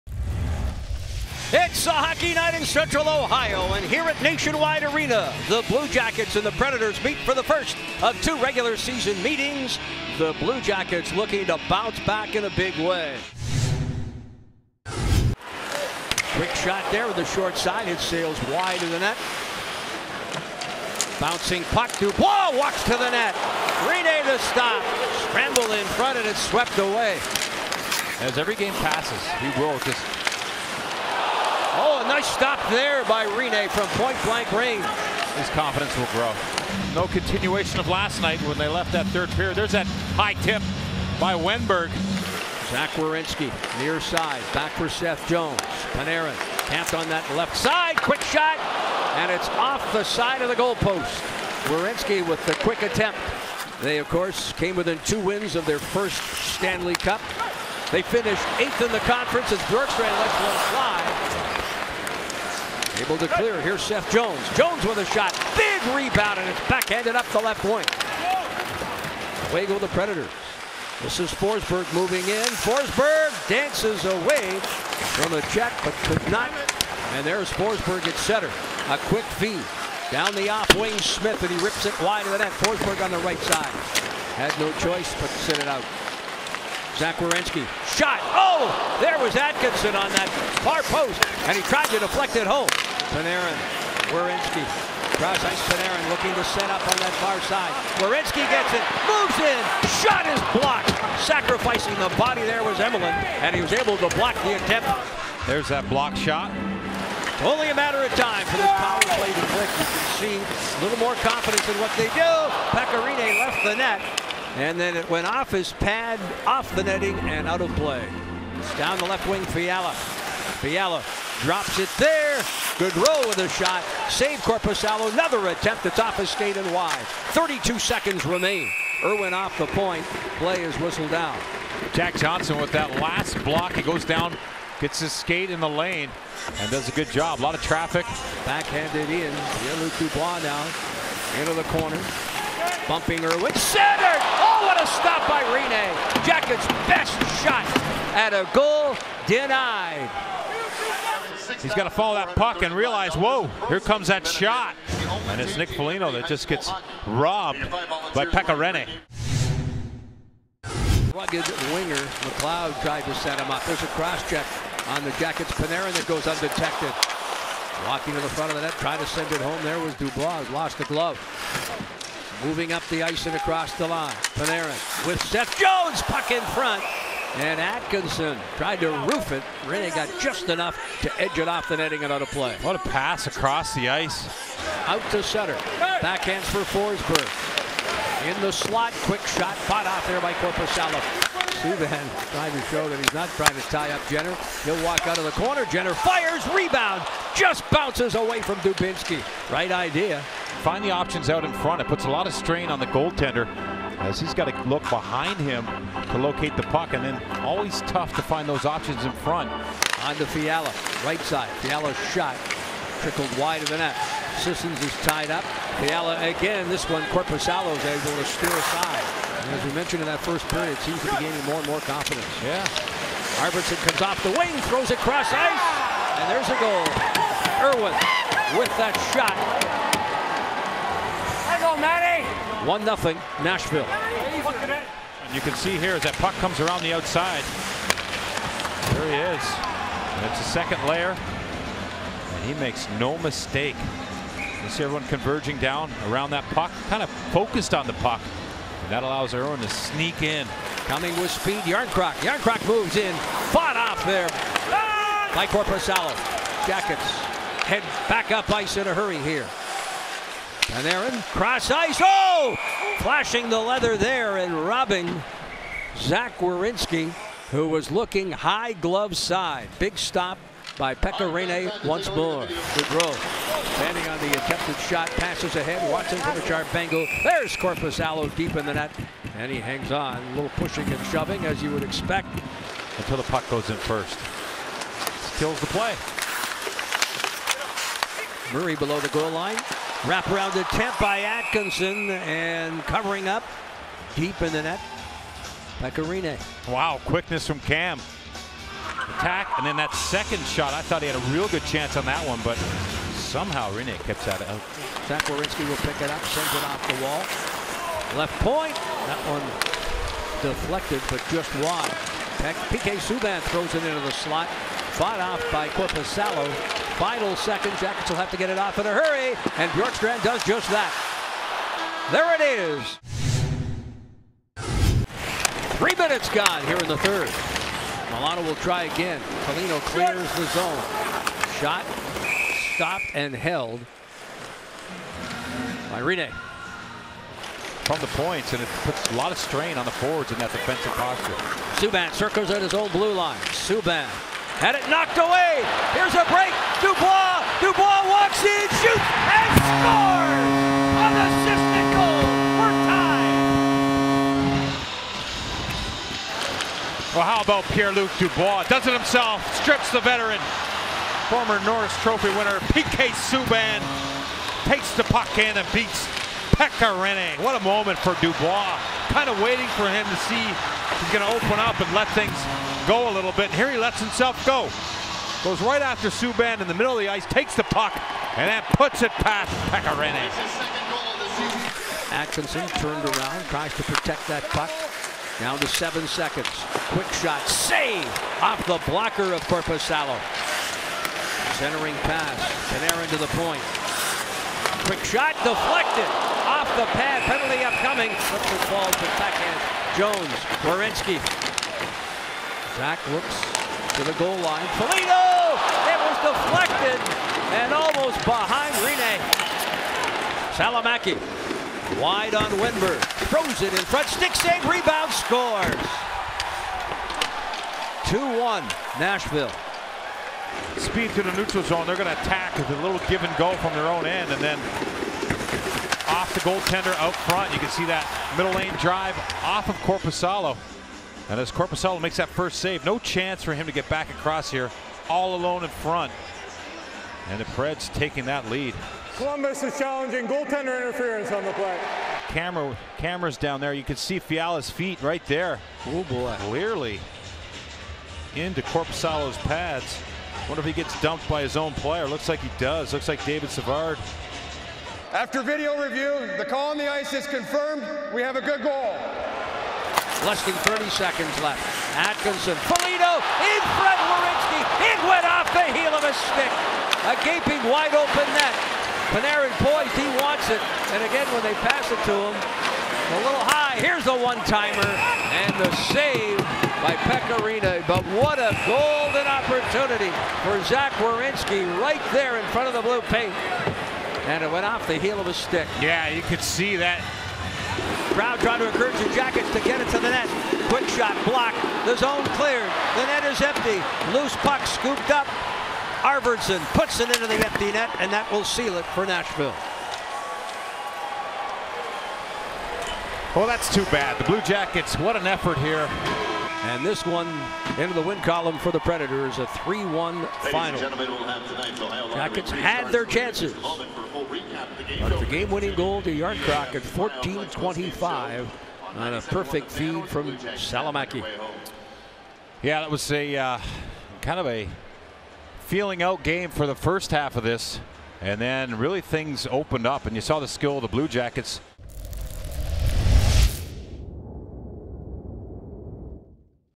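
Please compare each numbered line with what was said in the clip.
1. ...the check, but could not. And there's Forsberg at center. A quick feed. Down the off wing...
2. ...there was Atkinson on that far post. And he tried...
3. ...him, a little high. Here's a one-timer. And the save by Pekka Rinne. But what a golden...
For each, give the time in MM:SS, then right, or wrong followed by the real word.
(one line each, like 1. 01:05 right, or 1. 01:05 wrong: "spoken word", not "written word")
1. 01:15 right
2. 01:29 right
3. 07:52 right.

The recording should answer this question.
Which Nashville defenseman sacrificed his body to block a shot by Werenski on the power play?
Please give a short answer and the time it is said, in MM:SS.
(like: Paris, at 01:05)
Emelin, at 01:42.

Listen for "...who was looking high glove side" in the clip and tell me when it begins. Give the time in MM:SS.
04:27.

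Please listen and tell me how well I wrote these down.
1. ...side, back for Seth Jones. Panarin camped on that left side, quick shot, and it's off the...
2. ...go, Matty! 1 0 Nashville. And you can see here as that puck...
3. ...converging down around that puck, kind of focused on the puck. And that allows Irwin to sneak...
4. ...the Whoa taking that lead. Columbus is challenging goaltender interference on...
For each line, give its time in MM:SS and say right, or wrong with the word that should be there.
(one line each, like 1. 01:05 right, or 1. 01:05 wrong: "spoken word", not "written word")
1. 00:44 right
2. 03:51 right
3. 04:05 right
4. 07:17 wrong: "Preds", not "Whoa".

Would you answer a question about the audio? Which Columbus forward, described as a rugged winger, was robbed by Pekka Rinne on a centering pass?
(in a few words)
Nick Foligno.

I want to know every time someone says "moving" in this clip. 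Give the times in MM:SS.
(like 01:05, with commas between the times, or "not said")
01:11, 02:52.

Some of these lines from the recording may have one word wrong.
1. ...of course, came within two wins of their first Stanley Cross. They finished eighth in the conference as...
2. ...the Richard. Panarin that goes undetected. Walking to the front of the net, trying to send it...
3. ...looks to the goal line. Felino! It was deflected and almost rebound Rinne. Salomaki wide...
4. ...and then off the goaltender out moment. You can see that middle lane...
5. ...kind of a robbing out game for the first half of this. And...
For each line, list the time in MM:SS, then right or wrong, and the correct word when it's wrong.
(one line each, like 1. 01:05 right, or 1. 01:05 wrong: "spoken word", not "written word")
1. 00:53 wrong: "Cup", not "Cross"
2. 02:45 wrong: "Jackets", not "Richard"
3. 06:43 wrong: "behind", not "rebound"
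4. 07:04 wrong: "front", not "moment"
5. 08:44 wrong: "feeling", not "robbing".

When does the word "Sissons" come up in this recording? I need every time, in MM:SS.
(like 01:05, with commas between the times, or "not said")
03:34.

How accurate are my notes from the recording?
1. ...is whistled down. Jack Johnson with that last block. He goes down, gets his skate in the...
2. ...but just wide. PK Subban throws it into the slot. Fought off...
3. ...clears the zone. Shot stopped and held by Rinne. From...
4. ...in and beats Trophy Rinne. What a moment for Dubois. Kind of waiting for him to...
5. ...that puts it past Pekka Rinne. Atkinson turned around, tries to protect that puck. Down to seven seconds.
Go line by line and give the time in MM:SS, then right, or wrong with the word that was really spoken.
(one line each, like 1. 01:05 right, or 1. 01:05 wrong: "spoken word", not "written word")
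1. 02:10 right
2. 05:11 right
3. 05:29 right
4. 06:05 wrong: "Pekka", not "Trophy"
5. 06:18 right.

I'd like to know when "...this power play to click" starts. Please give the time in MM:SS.
01:48.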